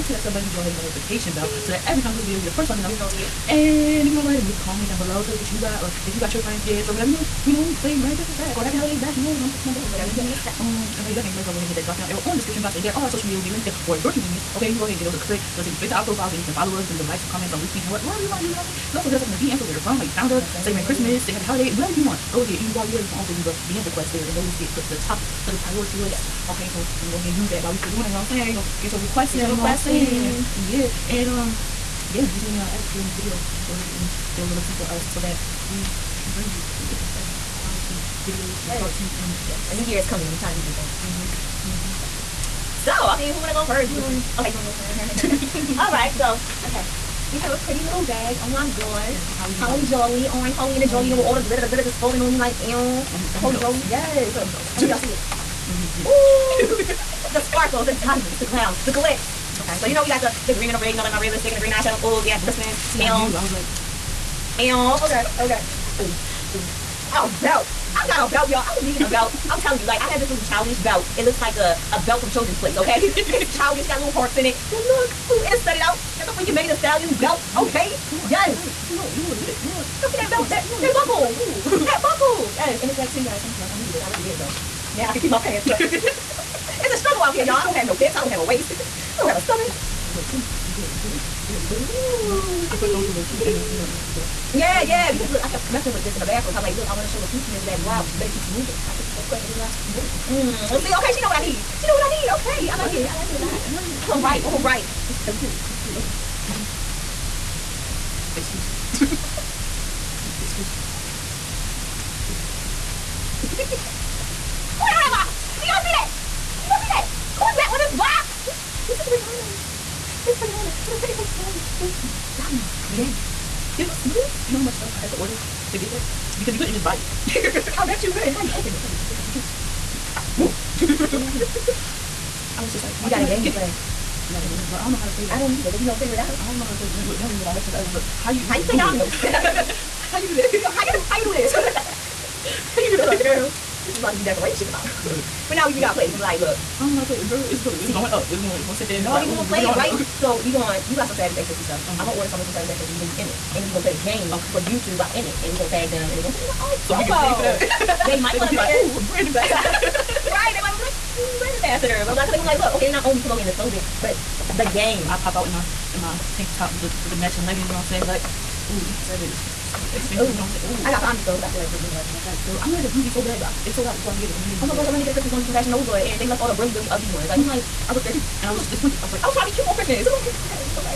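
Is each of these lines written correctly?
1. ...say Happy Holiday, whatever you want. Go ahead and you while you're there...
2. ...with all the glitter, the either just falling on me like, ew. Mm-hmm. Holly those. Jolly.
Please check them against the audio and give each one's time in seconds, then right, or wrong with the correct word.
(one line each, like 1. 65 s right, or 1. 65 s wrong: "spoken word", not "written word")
1. 21 s right
2. 51 s wrong: "glitter", not "either".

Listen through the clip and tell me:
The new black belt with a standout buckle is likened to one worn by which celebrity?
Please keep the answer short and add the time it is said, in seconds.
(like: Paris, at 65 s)
Megan Thee Stallion, at 76 s.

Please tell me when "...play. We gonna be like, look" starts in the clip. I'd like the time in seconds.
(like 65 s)
145 s.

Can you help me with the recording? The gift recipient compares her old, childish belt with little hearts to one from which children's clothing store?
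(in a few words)
Children's Place.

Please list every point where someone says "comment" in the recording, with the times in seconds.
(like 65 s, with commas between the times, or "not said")
4 s, 9 s, 17 s.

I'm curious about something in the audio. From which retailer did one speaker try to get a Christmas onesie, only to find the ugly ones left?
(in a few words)
Fashion Nova.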